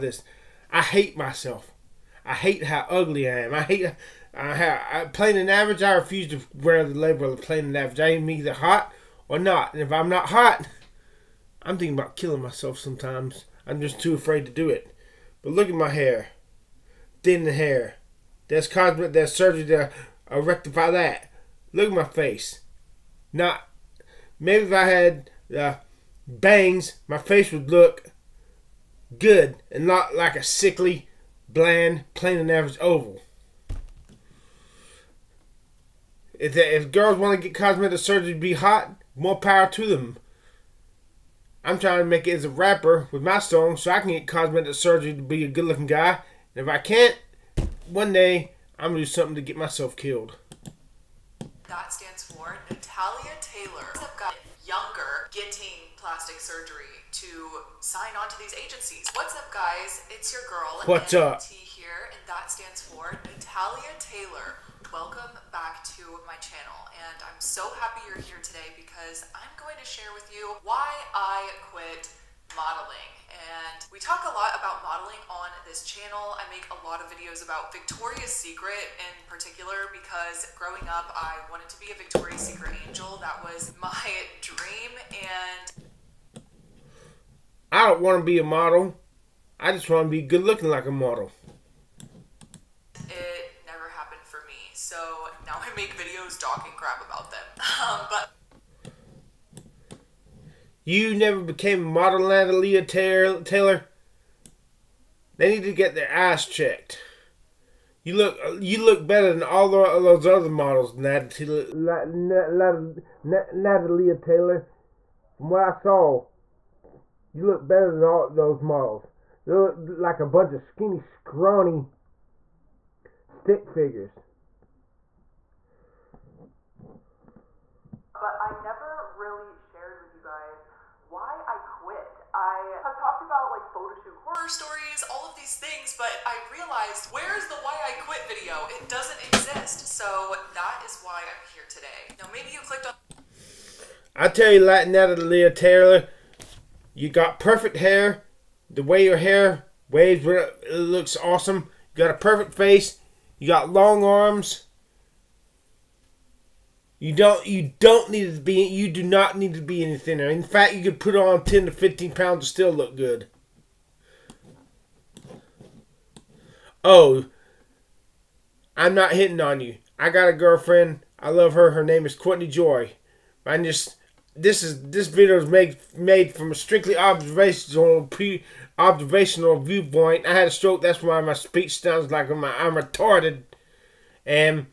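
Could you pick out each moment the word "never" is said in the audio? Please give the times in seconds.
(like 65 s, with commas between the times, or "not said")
101 s, 128 s.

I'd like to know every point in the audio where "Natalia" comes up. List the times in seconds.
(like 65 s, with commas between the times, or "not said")
52 s, 63 s, 102 s, 110 s.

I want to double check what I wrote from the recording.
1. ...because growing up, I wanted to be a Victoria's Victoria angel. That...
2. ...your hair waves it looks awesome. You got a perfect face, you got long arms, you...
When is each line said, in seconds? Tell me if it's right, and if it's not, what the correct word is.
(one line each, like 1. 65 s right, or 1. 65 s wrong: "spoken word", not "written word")
1. 79 s wrong: "Secret", not "Victoria"
2. 149 s right.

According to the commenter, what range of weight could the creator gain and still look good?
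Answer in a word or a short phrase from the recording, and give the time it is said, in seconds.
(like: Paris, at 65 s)
10 to 15 pounds, at 161 s.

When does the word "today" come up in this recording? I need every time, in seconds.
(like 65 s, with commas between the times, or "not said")
68 s, 141 s.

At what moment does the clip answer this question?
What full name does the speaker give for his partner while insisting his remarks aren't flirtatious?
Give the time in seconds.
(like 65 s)
172 s.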